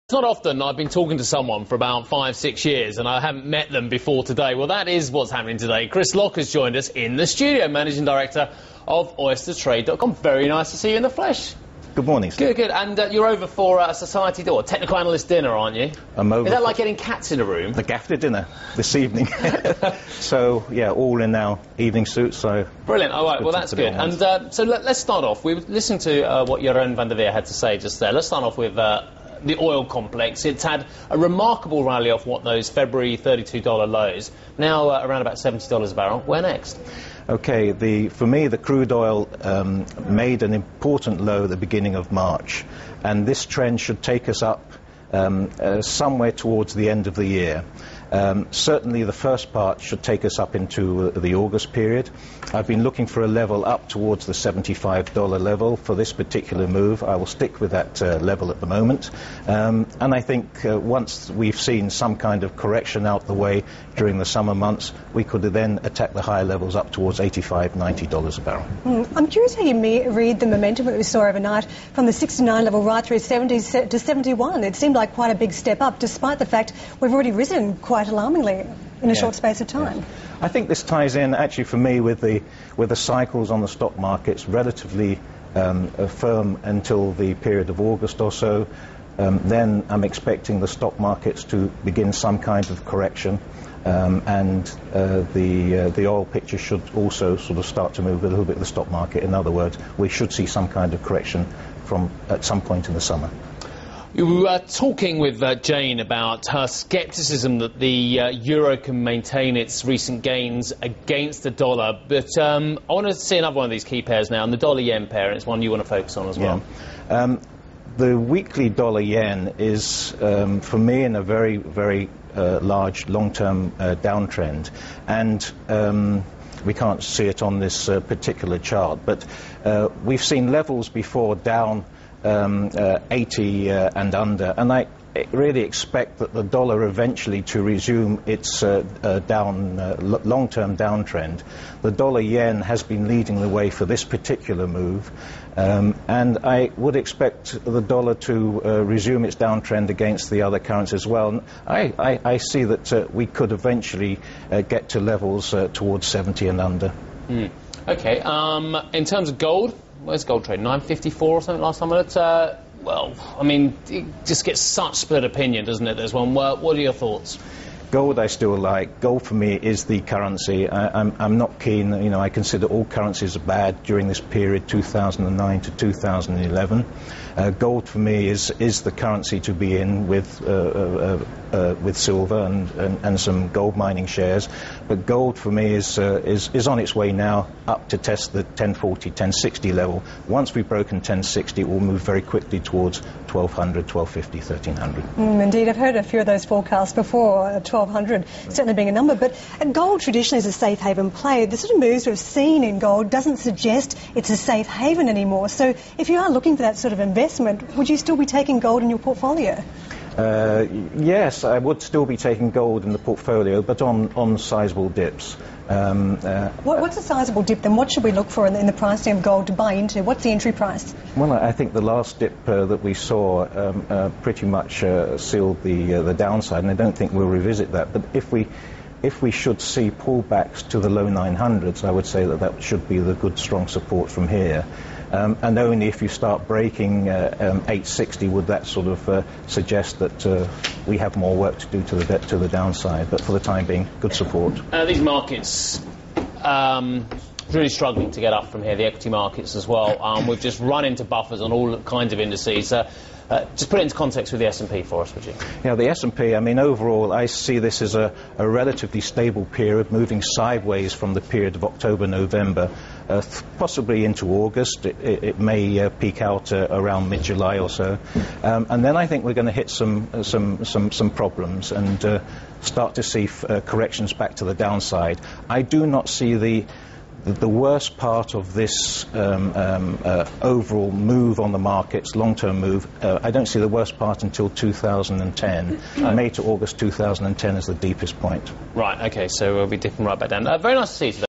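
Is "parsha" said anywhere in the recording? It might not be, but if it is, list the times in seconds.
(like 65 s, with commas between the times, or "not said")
not said.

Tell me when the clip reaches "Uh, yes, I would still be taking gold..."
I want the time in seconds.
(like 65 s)
210 s.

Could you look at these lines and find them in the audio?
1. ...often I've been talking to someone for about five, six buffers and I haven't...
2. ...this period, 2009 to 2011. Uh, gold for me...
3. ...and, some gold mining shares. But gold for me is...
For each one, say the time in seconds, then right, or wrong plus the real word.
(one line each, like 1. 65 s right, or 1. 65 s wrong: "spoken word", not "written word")
1. 0 s wrong: "years", not "buffers"
2. 174 s right
3. 183 s right.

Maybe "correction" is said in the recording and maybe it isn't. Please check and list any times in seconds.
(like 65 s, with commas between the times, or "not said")
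62 s, 92 s, 101 s, 273 s.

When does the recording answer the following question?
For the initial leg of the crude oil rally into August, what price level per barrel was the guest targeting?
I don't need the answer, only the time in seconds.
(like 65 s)
54 s.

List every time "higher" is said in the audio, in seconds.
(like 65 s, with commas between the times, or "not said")
66 s.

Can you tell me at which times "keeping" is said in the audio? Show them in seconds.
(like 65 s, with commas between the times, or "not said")
not said.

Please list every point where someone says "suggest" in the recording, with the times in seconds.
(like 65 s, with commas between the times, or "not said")
203 s, 239 s.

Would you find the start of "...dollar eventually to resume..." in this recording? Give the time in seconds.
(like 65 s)
136 s.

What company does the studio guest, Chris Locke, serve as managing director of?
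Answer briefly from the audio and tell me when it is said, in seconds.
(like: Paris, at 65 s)
OysterTrade.com, at 9 s.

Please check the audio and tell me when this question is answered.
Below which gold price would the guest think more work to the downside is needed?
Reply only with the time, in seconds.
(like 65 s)
237 s.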